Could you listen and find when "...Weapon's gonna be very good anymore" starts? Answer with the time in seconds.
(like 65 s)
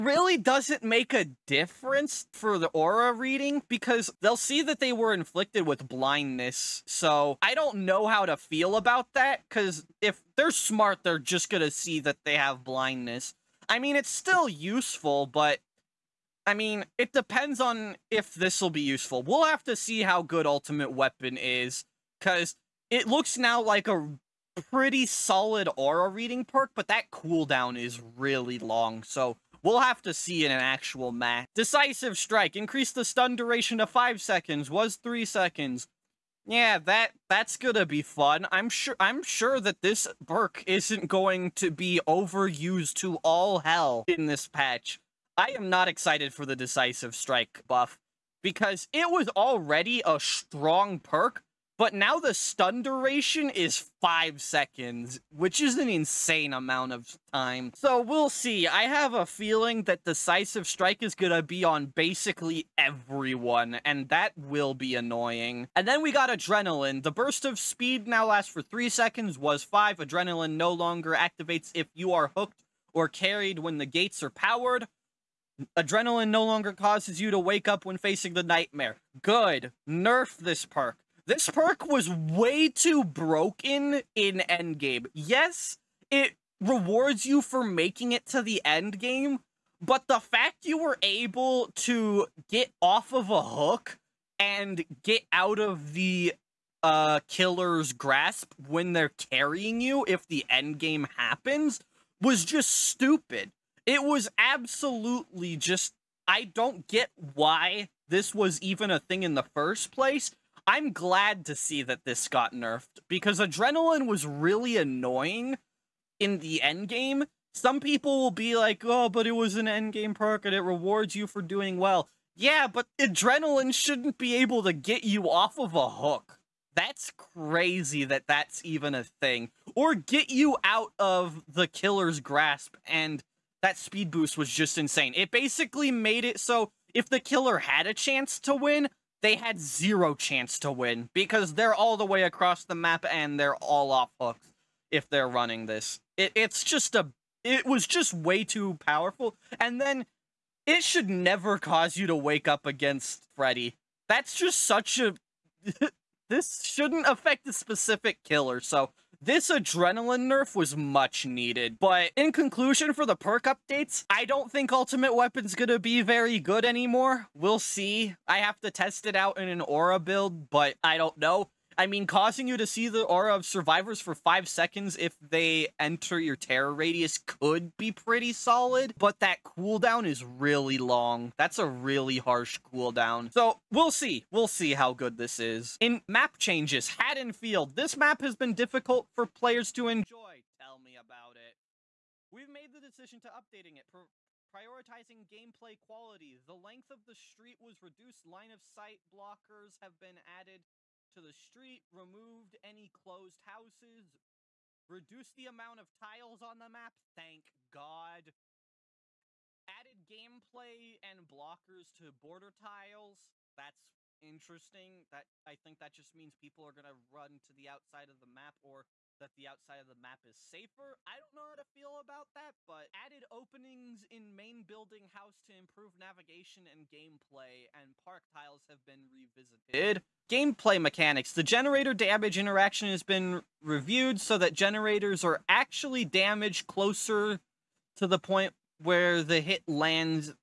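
165 s.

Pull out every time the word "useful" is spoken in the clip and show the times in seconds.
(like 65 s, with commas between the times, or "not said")
14 s, 18 s.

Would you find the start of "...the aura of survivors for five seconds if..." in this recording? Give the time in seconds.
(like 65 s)
172 s.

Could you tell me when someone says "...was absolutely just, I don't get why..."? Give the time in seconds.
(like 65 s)
104 s.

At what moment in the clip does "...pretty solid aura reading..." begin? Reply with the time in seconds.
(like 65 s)
24 s.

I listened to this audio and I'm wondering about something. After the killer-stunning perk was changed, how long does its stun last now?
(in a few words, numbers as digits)
5 seconds.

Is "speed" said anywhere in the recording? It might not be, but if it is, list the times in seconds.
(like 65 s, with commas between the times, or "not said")
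67 s, 133 s.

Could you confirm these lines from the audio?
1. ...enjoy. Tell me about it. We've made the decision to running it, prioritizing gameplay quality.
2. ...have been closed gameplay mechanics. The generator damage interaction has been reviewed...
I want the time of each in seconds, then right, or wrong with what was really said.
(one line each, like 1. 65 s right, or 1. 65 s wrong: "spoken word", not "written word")
1. 189 s wrong: "updating", not "running"
2. 228 s wrong: "revisited", not "closed".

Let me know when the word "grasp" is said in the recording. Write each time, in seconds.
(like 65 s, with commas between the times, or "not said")
97 s, 132 s.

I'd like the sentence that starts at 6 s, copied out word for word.
So I don't know how to feel about that because if they're smart, they're just gonna see that they have blindness.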